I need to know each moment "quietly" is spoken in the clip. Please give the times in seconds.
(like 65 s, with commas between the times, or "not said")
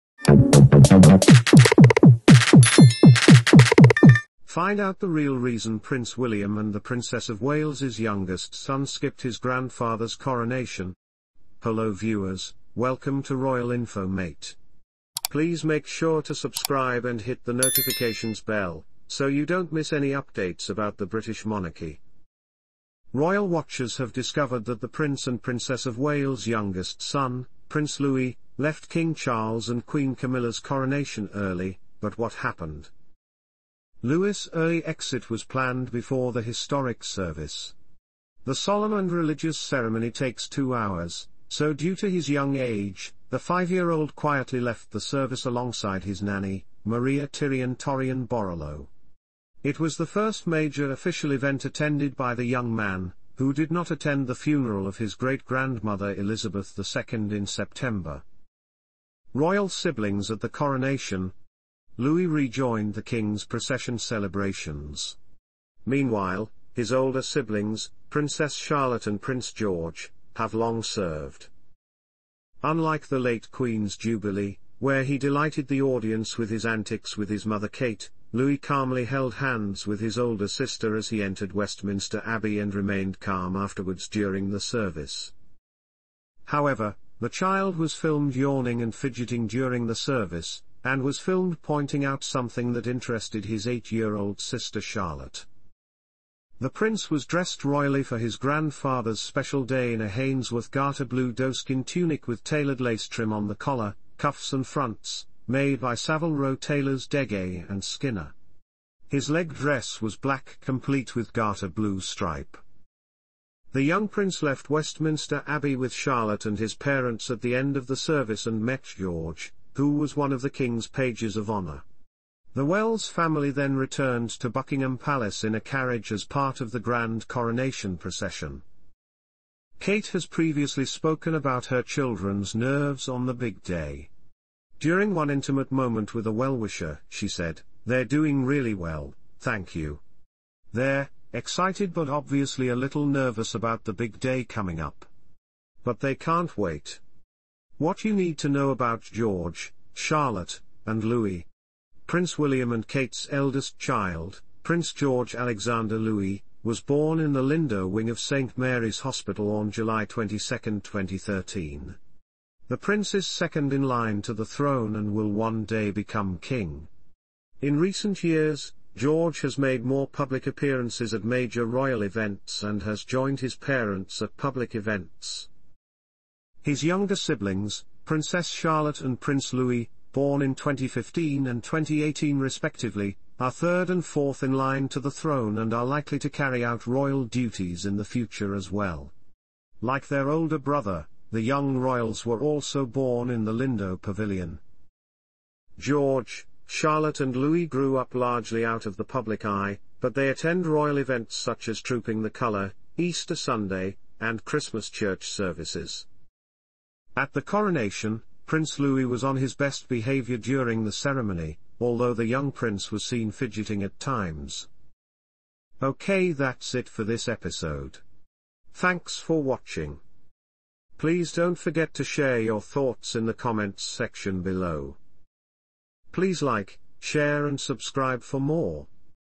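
44 s.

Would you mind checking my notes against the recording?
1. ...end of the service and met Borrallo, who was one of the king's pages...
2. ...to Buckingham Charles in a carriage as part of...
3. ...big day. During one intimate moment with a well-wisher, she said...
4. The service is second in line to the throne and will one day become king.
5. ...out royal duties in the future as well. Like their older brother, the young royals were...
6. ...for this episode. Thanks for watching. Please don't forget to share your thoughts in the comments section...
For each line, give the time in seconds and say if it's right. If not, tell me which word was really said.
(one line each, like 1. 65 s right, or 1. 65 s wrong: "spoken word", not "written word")
1. 117 s wrong: "George", not "Borrallo"
2. 124 s wrong: "Palace", not "Charles"
3. 133 s right
4. 162 s wrong: "prince", not "service"
5. 186 s right
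6. 216 s right.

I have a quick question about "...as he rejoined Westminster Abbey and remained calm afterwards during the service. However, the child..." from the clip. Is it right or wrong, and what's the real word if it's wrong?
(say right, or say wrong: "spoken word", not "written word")
wrong: "entered", not "rejoined".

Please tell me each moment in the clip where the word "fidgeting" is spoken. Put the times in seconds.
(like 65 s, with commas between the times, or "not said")
88 s, 213 s.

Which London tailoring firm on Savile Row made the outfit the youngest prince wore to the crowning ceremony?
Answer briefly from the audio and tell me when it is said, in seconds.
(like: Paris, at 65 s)
Dege and Skinner, at 107 s.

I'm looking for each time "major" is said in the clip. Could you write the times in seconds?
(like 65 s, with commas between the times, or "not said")
50 s, 171 s.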